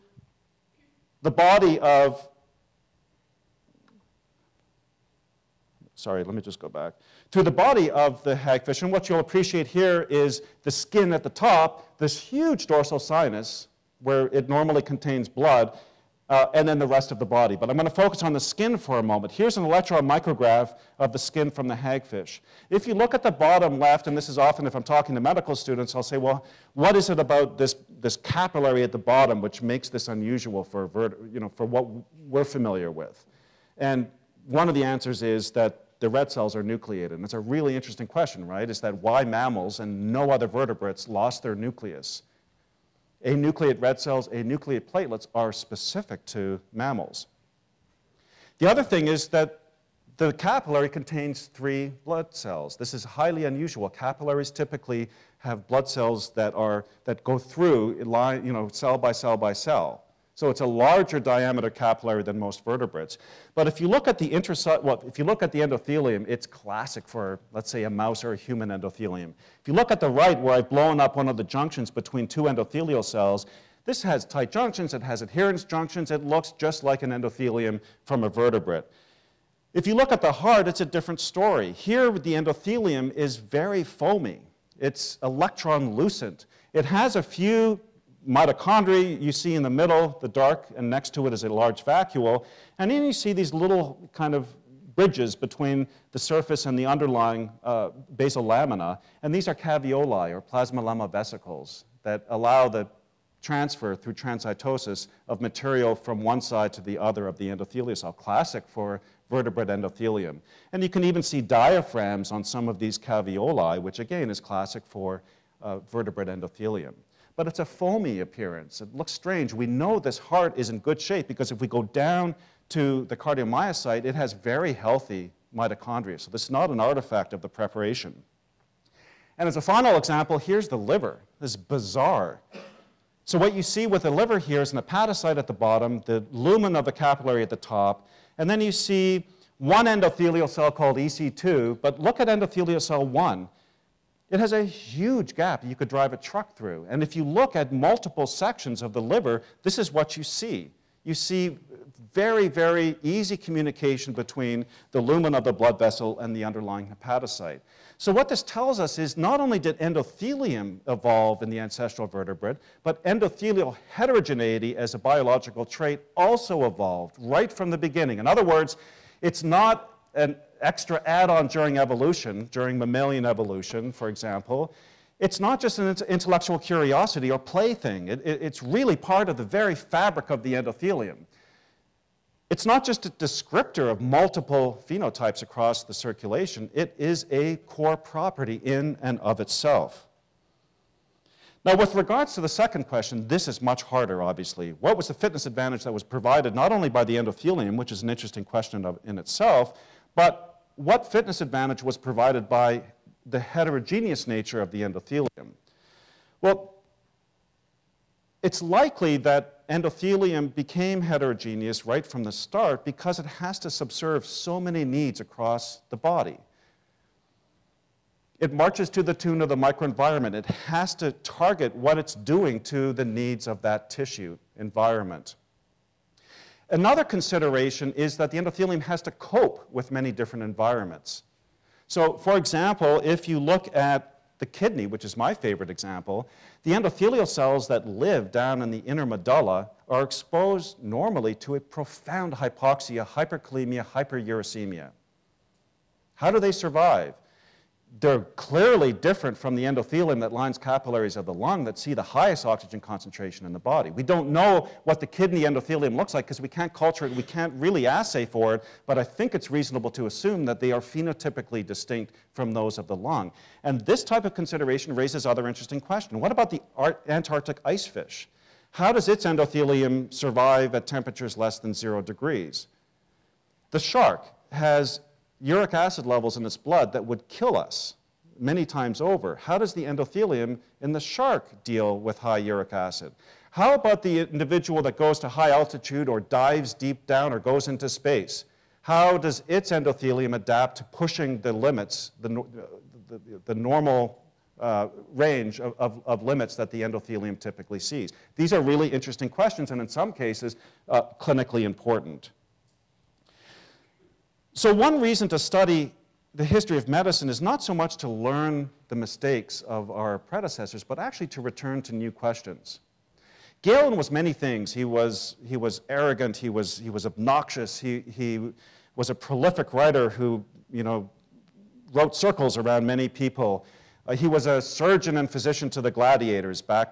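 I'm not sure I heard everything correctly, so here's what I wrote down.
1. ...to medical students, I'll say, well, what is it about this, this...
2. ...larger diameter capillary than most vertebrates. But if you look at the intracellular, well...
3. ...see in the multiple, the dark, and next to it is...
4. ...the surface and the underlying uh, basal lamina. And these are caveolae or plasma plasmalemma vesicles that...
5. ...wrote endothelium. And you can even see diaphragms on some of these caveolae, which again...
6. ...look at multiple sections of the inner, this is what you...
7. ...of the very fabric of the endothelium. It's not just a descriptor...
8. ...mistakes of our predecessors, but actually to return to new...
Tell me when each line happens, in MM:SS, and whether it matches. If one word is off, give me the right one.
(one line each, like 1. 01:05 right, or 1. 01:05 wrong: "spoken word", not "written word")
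1. 00:25 right
2. 01:00 right
3. 01:29 wrong: "middle", not "multiple"
4. 01:36 right
5. 01:49 wrong: "vertebrate", not "wrote"
6. 02:27 wrong: "liver", not "inner"
7. 02:59 right
8. 05:08 right.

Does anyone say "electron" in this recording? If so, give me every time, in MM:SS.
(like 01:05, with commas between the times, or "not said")
00:19, 01:25.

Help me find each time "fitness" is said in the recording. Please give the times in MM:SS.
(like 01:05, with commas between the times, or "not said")
03:15, 03:21.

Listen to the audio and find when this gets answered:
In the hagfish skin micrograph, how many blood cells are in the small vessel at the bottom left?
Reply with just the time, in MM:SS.
00:51.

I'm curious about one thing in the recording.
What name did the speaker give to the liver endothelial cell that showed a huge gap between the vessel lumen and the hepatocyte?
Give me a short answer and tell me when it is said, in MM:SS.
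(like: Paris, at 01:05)
Endothelial cell 1, at 02:22.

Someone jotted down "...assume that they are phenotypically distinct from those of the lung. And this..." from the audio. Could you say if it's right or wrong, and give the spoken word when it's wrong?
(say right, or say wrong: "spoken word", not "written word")
right.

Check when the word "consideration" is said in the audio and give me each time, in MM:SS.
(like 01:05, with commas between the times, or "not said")
03:47, 04:24.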